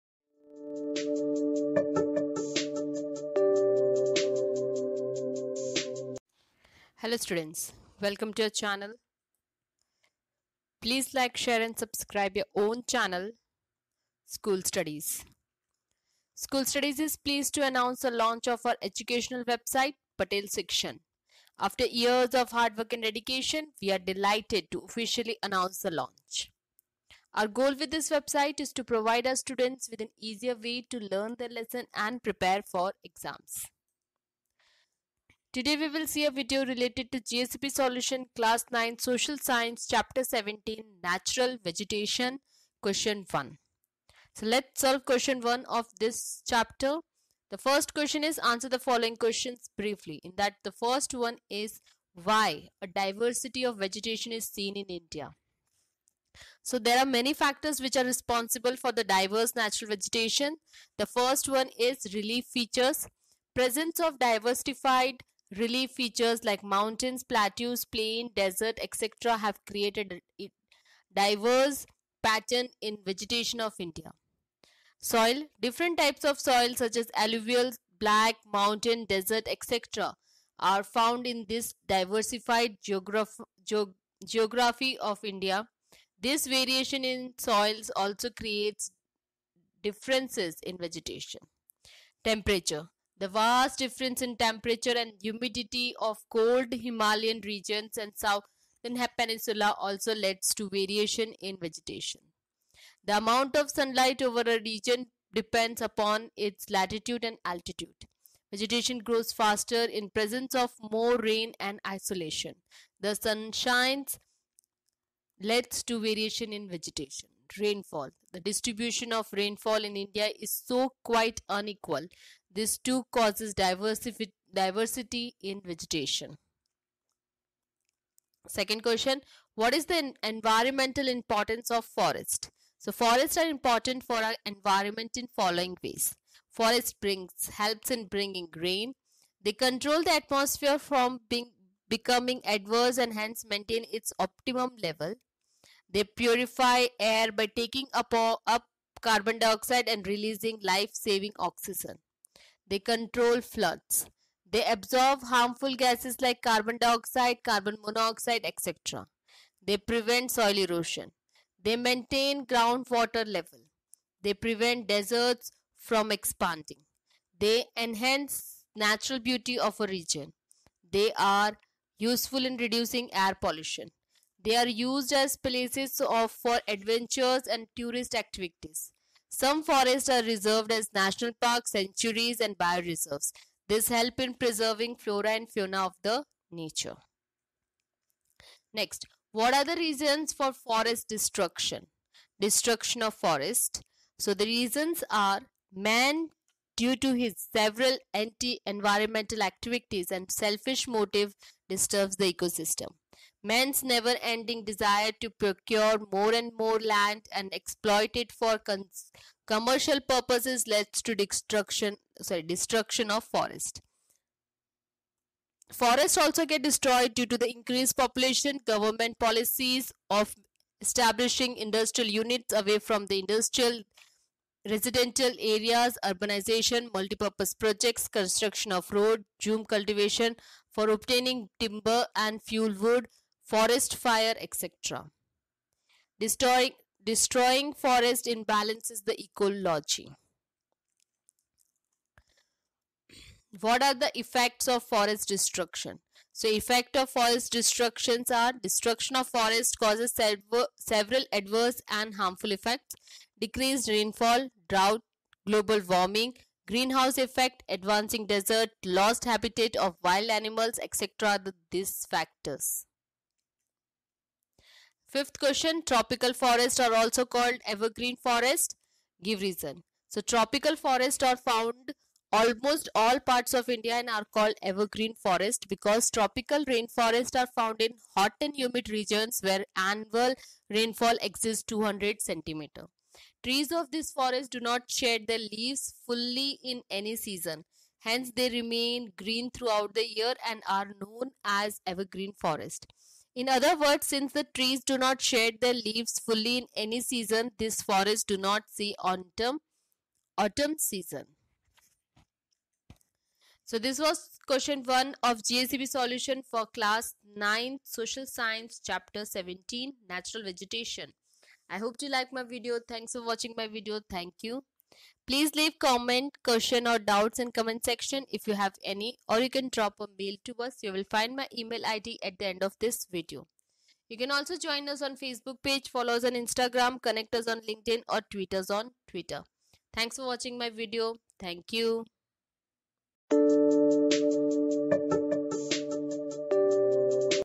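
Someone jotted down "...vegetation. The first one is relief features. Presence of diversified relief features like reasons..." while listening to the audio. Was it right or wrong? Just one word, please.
wrong.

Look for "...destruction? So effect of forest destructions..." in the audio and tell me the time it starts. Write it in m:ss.
4:05.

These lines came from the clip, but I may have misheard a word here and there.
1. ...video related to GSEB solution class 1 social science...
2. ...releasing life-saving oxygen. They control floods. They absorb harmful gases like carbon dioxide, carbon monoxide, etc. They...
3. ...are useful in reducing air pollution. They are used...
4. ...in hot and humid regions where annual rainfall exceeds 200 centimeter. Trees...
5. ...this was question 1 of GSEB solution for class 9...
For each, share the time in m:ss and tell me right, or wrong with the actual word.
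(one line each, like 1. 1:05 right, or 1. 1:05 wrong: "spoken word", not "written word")
1. 0:36 wrong: "9", not "1"
2. 2:30 right
3. 2:51 right
4. 4:37 right
5. 5:03 right.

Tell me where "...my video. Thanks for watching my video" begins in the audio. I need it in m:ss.
5:12.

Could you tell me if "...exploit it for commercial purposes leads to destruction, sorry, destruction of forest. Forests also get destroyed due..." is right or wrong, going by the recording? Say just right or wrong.
right.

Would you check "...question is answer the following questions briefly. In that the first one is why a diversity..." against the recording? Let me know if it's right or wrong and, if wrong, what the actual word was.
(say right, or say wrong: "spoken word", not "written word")
right.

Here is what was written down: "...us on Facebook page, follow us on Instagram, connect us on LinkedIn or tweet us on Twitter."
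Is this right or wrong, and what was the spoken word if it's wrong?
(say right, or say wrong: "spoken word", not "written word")
right.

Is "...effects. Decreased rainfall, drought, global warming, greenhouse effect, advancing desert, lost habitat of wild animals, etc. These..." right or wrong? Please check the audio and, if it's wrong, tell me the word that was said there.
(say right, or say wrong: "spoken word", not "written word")
right.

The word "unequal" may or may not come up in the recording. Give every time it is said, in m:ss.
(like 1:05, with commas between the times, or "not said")
2:01.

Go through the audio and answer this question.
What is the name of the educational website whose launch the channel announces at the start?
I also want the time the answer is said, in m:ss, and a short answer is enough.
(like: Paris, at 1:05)
Patel Shikshan, at 0:20.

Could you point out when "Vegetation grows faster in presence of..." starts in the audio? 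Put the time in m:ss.
1:48.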